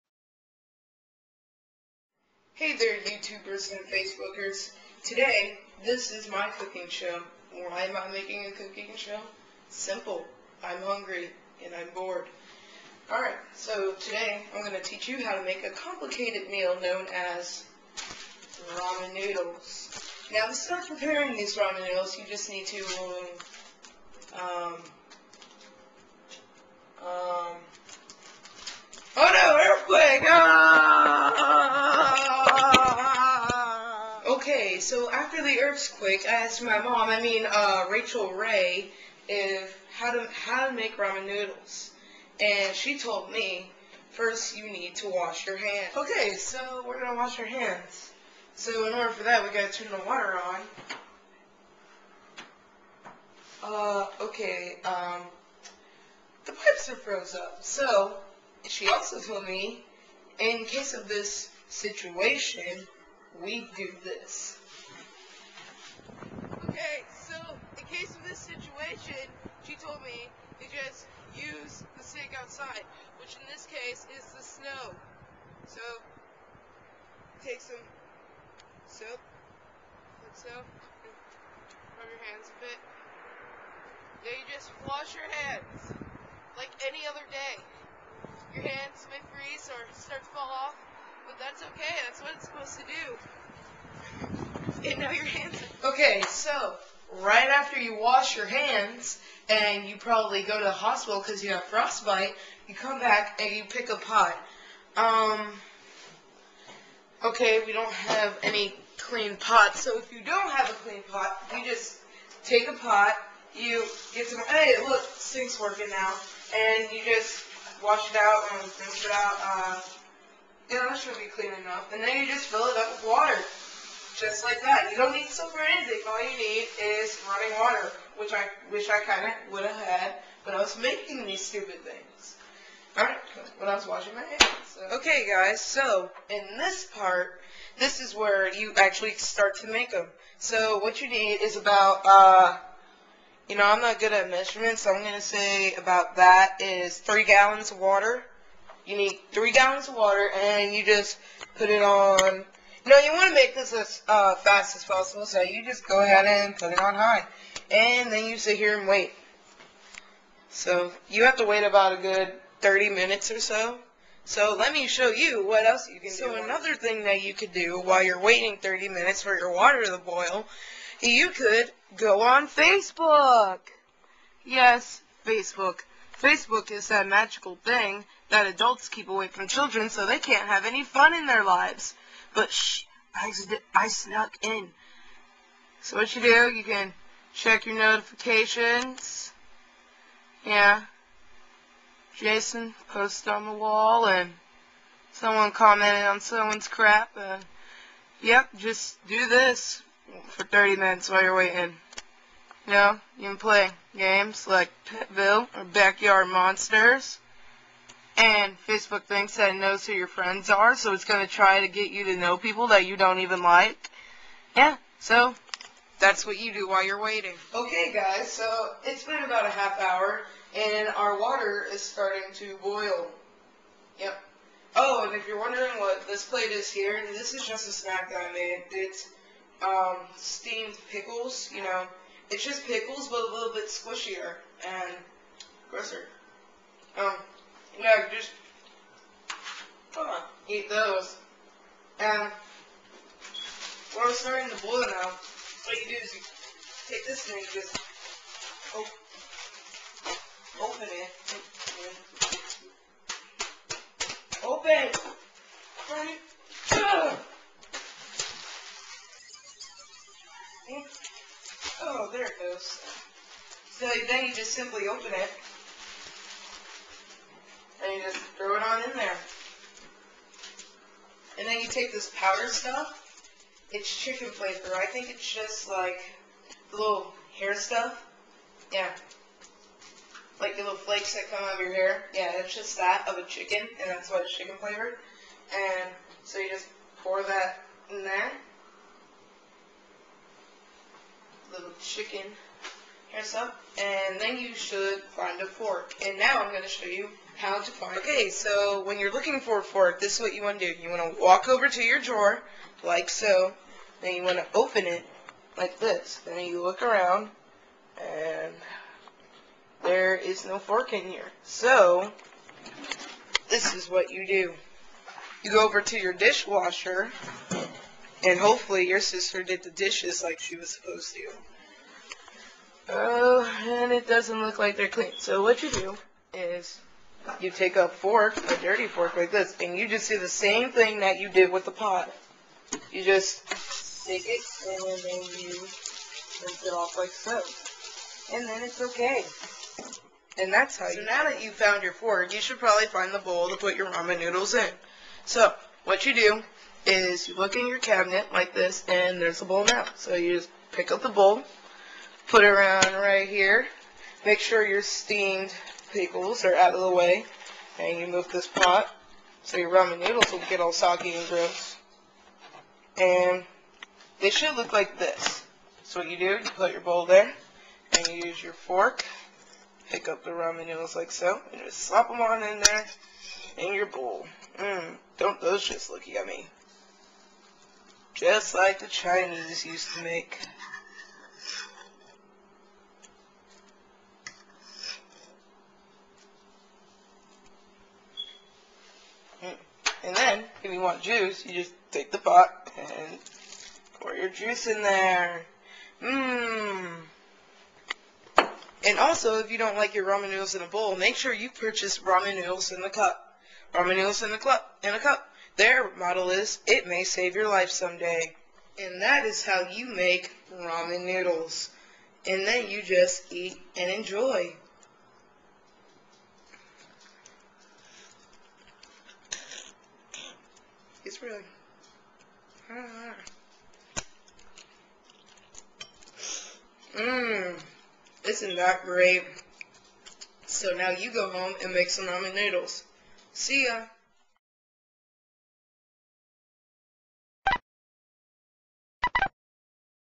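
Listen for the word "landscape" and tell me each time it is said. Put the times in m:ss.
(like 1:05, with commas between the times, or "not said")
not said.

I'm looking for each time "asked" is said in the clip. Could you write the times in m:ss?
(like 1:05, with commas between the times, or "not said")
0:36.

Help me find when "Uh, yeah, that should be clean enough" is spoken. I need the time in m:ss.
1:59.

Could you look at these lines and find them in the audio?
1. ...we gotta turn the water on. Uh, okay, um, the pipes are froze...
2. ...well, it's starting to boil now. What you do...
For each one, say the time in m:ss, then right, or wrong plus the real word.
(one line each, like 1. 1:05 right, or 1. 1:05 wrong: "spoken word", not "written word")
1. 0:49 right
2. 4:03 right.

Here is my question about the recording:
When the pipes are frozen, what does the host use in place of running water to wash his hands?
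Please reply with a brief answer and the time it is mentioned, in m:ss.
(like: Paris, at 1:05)
The snow, at 1:14.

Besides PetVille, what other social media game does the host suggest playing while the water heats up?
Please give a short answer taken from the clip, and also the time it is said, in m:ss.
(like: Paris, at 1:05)
Backyard Monsters, at 3:25.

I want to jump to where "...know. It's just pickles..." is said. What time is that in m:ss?
3:51.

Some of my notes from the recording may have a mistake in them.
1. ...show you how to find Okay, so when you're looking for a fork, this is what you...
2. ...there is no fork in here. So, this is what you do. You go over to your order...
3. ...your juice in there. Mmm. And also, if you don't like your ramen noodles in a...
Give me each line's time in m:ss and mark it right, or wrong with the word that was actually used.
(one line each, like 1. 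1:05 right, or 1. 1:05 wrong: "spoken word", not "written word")
1. 4:56 right
2. 5:09 wrong: "dishwasher", not "order"
3. 6:34 right.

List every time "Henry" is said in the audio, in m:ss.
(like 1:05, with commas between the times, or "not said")
not said.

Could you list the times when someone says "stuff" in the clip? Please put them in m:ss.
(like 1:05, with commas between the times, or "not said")
4:32, 4:37, 4:53.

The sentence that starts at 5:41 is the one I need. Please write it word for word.
now that you found your fork, you should probably find the bowl to put your ramen noodles in.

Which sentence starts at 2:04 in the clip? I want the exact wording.
You don't need soap or anything.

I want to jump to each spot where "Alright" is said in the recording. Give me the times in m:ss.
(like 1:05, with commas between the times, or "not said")
0:13, 2:12.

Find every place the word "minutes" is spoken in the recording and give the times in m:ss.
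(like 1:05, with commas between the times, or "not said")
2:42, 2:48, 3:20.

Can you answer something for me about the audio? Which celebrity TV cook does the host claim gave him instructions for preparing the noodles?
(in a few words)
Rachael Ray.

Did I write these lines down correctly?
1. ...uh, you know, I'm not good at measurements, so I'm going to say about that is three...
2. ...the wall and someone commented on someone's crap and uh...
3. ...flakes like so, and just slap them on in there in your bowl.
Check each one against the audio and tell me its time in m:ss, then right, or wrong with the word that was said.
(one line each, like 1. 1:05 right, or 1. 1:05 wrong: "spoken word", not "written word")
1. 2:22 right
2. 3:13 right
3. 6:10 wrong: "noodles", not "flakes".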